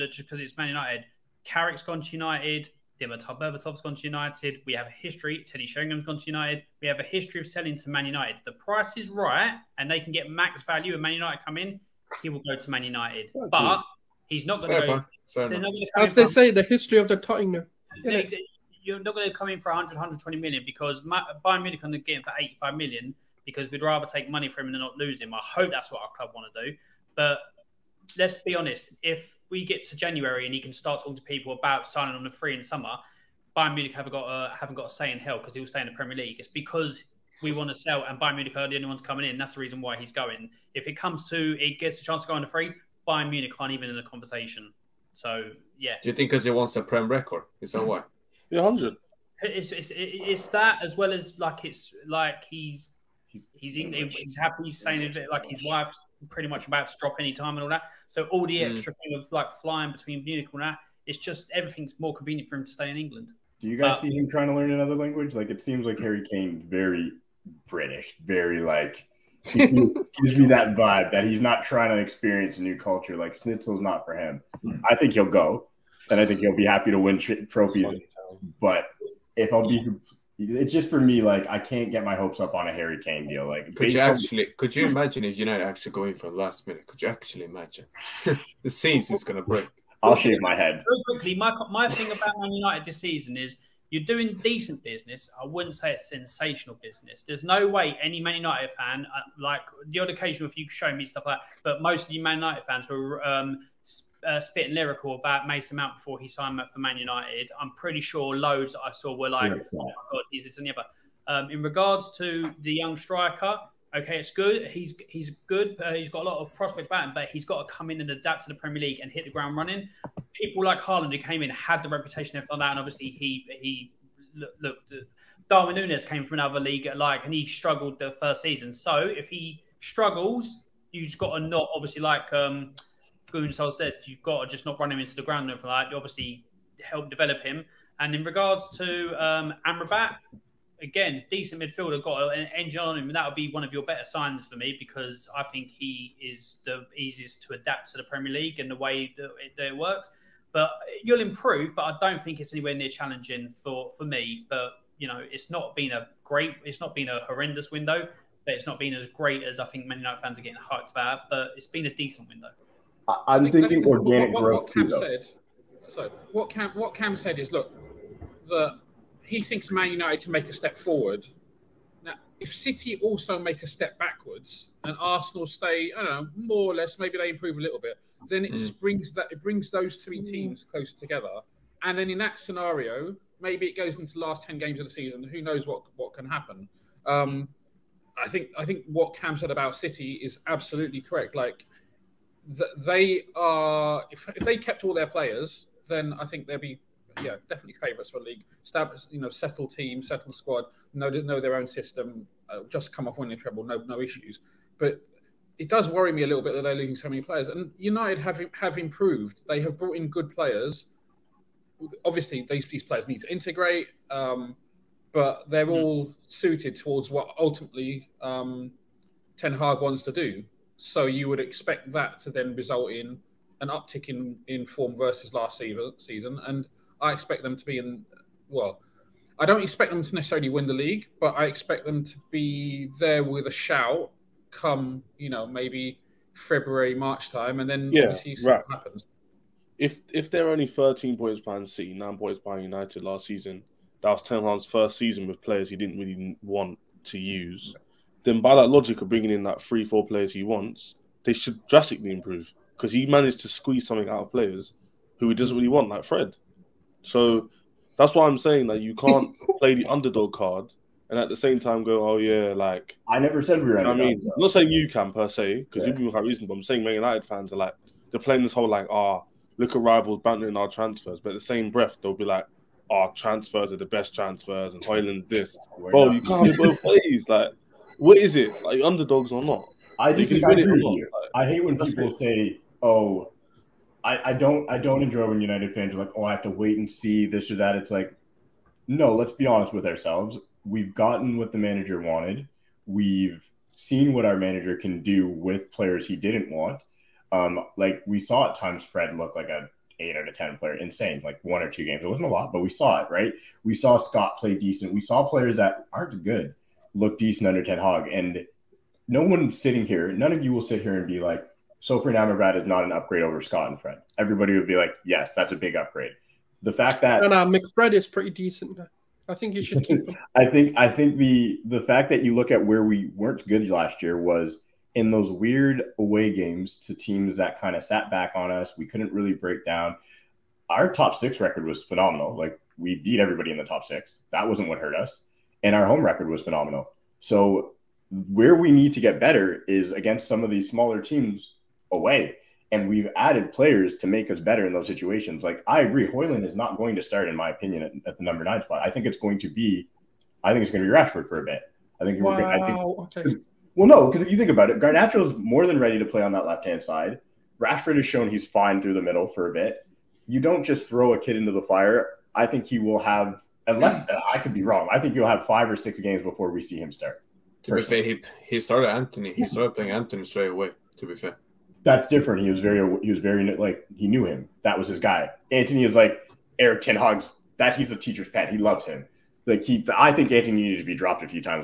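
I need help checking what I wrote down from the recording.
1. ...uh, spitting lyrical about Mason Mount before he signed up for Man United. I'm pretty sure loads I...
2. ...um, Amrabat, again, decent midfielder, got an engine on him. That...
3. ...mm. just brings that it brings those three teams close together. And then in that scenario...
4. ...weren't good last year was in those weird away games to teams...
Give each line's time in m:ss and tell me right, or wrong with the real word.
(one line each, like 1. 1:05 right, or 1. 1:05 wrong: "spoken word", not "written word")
1. 1:44 right
2. 2:19 right
3. 2:58 right
4. 5:23 right.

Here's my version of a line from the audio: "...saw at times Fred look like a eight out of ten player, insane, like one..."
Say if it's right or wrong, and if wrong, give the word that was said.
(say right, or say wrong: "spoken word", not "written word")
right.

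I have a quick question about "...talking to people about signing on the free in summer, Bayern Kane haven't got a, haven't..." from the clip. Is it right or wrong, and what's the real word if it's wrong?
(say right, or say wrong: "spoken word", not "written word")
wrong: "Munich", not "Kane".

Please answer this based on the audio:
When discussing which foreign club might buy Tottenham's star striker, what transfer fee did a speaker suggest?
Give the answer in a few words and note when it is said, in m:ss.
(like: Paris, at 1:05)
85 million, at 0:22.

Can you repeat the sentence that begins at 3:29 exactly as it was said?
They have brought in good players.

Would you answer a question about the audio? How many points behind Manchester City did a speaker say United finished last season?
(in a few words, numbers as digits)
13.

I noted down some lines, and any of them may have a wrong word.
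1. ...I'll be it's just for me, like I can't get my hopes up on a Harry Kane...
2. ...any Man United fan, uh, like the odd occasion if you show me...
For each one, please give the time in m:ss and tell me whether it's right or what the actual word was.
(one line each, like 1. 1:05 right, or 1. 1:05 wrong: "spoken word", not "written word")
1. 1:19 right
2. 1:38 right.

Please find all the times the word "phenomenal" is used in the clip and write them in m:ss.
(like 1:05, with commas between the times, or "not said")
5:31, 5:36.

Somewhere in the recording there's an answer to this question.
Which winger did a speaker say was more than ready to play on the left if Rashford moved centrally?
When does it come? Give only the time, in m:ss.
5:54.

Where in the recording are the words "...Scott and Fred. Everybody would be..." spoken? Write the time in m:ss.
5:13.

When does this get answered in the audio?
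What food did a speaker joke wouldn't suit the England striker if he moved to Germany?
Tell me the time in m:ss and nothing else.
1:13.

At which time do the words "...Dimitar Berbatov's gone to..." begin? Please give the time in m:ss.
0:03.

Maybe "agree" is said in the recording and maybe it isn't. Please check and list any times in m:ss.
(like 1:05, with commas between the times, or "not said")
4:40, 5:45.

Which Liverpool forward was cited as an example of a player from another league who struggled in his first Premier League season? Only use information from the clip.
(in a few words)
Darwin Nunez.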